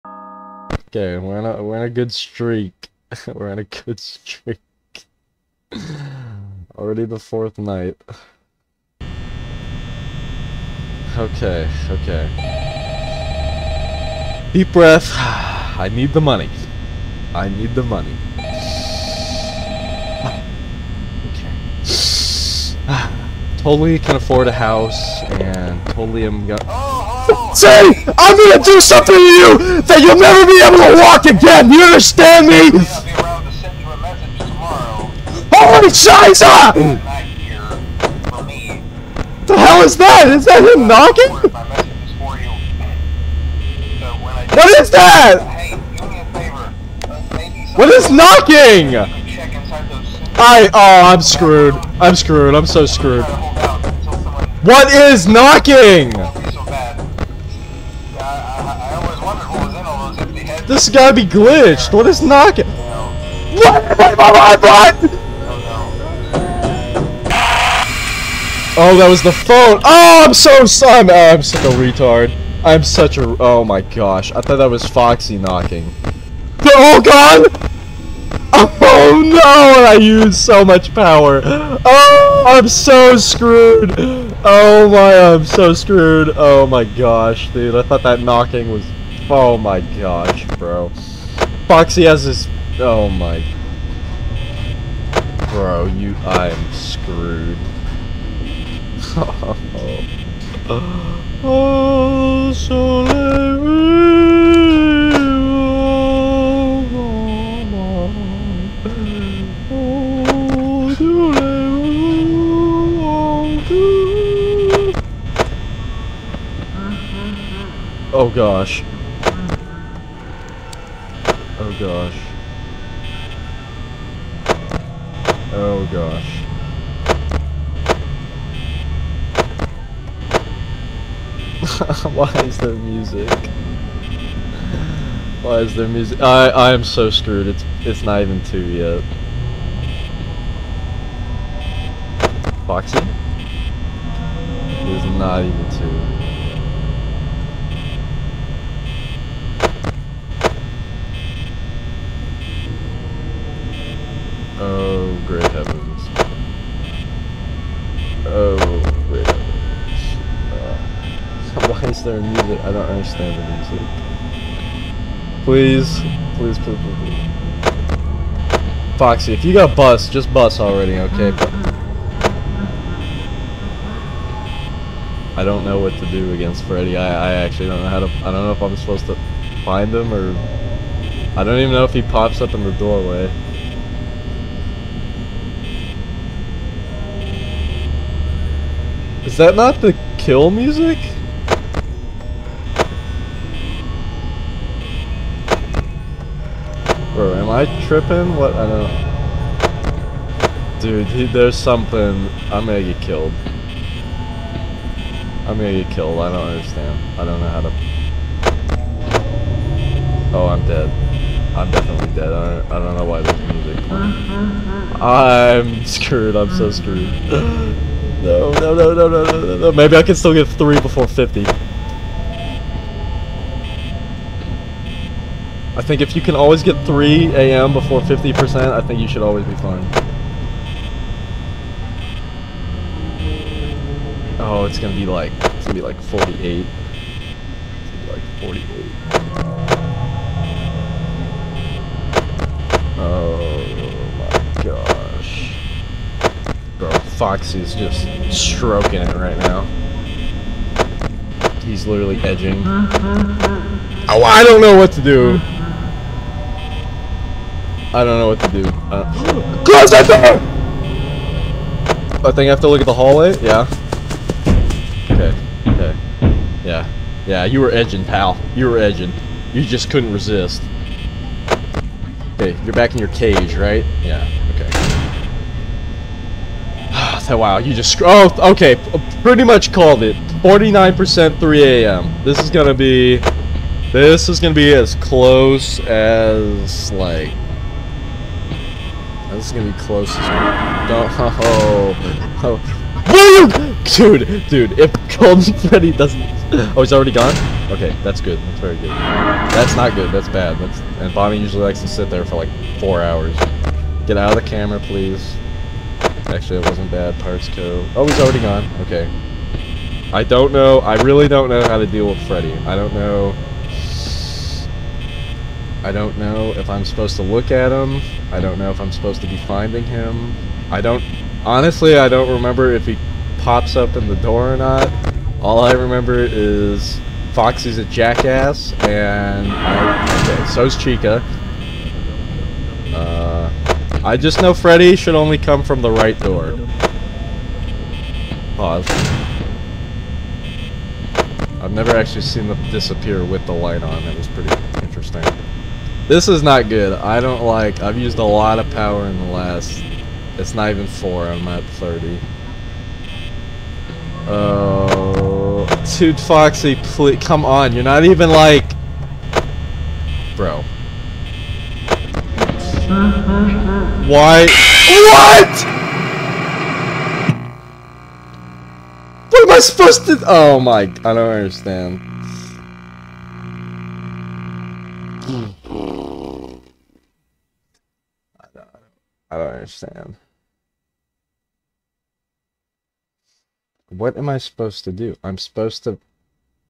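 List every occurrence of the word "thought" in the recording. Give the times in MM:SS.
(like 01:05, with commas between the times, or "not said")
01:14, 01:27.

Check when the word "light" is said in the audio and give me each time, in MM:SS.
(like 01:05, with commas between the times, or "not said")
05:43.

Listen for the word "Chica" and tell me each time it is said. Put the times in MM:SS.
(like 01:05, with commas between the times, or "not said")
05:30.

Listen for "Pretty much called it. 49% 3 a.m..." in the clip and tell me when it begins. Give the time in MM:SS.
04:39.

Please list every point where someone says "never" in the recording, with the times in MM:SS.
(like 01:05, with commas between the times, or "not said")
00:30, 05:41.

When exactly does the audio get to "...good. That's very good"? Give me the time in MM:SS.
04:58.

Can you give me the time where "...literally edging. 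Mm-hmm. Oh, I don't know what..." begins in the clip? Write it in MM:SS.
04:11.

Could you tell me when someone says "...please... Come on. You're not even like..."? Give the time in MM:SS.
05:56.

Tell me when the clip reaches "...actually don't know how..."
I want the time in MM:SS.
02:57.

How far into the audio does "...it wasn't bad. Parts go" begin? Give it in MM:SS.
05:06.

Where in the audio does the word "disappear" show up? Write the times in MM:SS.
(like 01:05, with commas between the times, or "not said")
05:42.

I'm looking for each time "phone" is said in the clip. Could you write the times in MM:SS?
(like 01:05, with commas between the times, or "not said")
01:09.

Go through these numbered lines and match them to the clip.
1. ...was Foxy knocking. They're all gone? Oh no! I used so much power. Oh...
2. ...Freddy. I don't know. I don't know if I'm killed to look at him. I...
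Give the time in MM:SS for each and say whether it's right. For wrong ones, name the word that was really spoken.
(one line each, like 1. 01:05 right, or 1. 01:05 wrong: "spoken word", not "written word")
1. 01:14 right
2. 05:12 wrong: "supposed", not "killed".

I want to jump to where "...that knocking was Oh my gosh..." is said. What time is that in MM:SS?
01:28.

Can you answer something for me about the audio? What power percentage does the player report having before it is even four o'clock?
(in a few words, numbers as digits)
30.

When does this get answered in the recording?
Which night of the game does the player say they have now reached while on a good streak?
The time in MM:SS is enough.
00:07.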